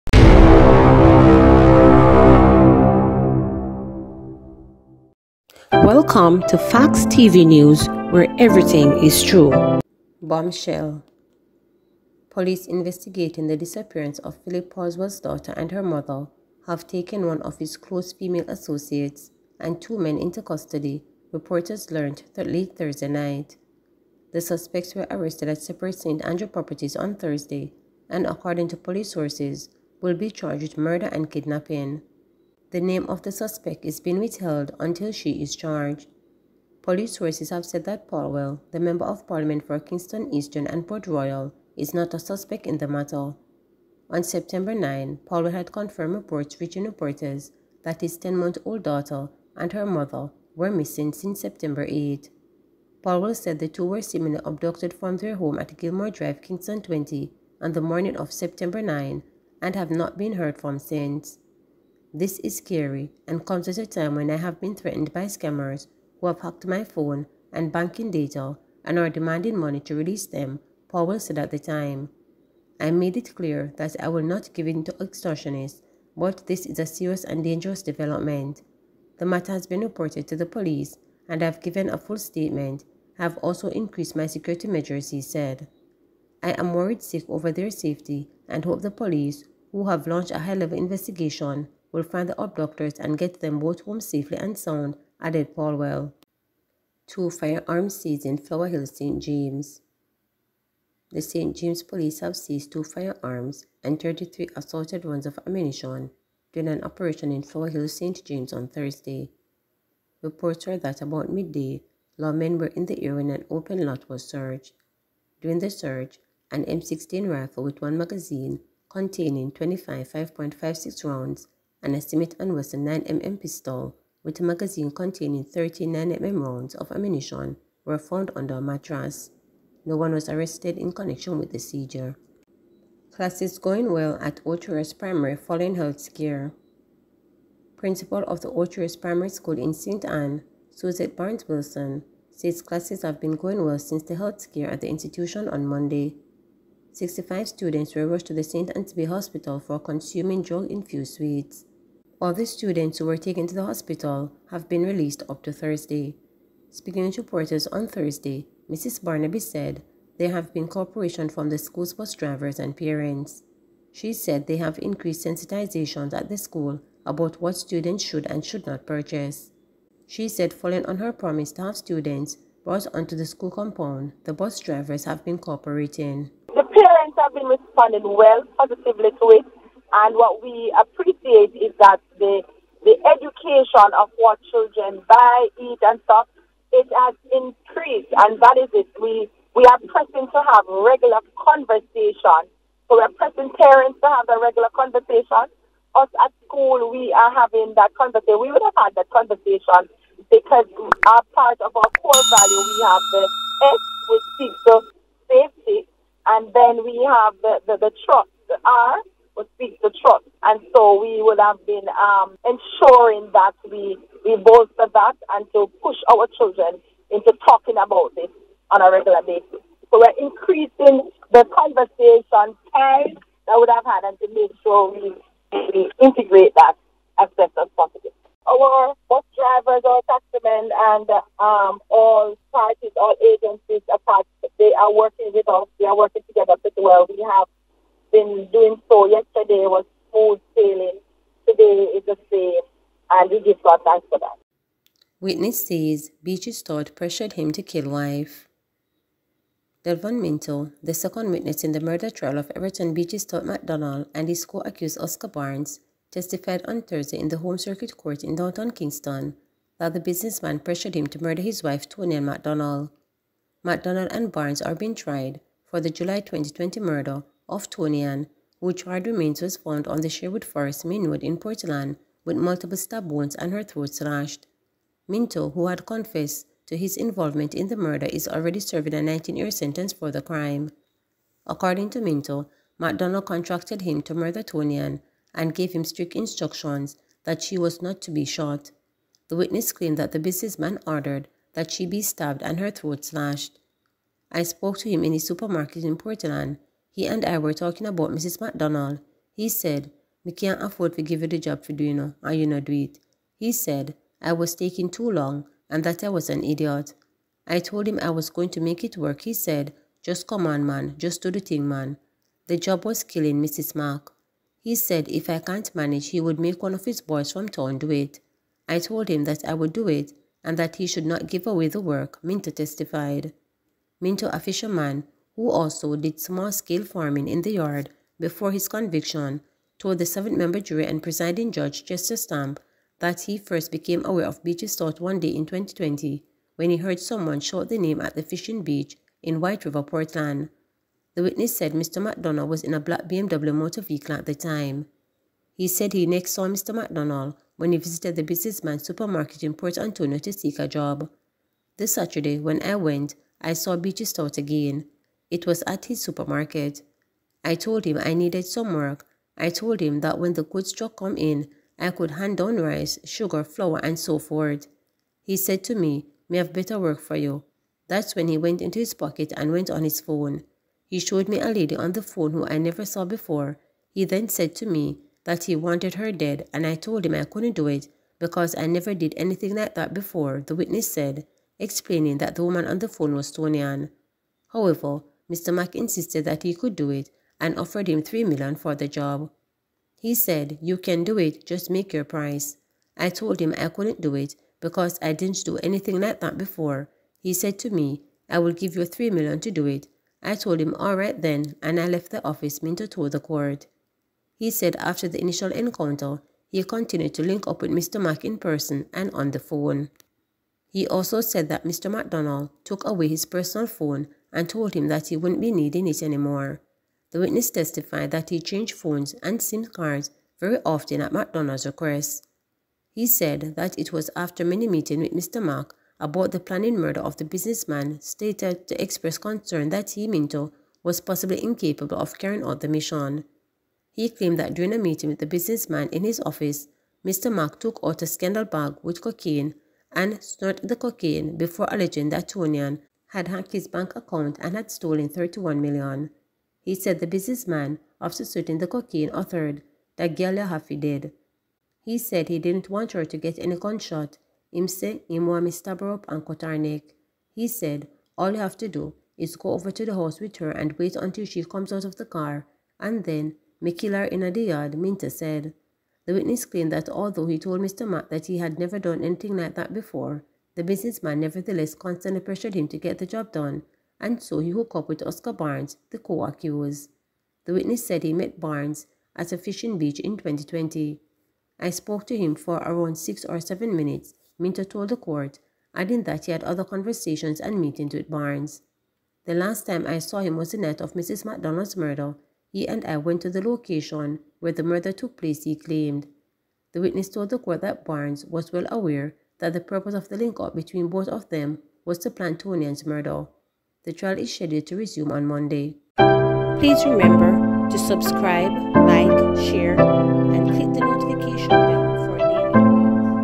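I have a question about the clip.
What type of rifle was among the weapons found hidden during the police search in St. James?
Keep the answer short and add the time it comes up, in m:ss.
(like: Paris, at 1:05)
M16, at 1:56.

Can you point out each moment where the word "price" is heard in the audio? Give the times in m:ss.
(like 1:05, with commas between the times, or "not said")
6:32.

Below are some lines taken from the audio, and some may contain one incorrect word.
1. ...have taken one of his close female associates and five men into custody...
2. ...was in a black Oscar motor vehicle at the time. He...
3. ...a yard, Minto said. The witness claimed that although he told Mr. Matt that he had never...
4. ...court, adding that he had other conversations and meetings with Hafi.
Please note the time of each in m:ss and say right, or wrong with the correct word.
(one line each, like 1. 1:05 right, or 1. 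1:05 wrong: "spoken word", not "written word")
1. 0:16 wrong: "two", not "five"
2. 5:42 wrong: "BMW", not "Oscar"
3. 7:44 right
4. 8:04 wrong: "Barnes", not "Hafi".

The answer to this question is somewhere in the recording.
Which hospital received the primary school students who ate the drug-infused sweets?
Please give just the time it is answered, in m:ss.
2:28.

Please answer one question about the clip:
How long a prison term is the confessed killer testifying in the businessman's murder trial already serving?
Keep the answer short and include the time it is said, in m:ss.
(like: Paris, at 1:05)
19 years, at 4:38.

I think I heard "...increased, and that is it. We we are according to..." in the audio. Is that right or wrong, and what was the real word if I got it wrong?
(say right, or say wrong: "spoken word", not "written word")
wrong: "pressing", not "according".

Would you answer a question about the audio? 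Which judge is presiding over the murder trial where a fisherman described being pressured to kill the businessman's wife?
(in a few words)
Chester Stamp.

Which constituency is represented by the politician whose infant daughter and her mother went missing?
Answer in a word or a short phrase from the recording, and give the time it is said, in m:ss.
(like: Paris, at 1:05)
Kingston Eastern and Port Royal, at 0:39.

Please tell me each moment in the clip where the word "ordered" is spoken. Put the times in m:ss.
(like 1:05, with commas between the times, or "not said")
4:50.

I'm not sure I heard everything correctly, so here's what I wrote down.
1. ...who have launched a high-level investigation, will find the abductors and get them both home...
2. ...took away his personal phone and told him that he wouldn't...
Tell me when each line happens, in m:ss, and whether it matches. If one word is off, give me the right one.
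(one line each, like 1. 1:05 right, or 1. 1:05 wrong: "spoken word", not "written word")
1. 1:29 right
2. 6:52 right.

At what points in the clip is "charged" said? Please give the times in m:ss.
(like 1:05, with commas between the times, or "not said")
0:30, 0:35.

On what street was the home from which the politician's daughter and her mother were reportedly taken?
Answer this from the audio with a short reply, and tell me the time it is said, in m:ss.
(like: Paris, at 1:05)
Gilmore Drive, at 0:55.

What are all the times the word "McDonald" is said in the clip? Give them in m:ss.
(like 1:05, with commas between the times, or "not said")
4:42, 5:42, 5:46, 6:51, 7:01, 8:11.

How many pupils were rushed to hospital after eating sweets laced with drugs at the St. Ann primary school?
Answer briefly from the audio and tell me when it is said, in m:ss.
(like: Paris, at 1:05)
65, at 2:26.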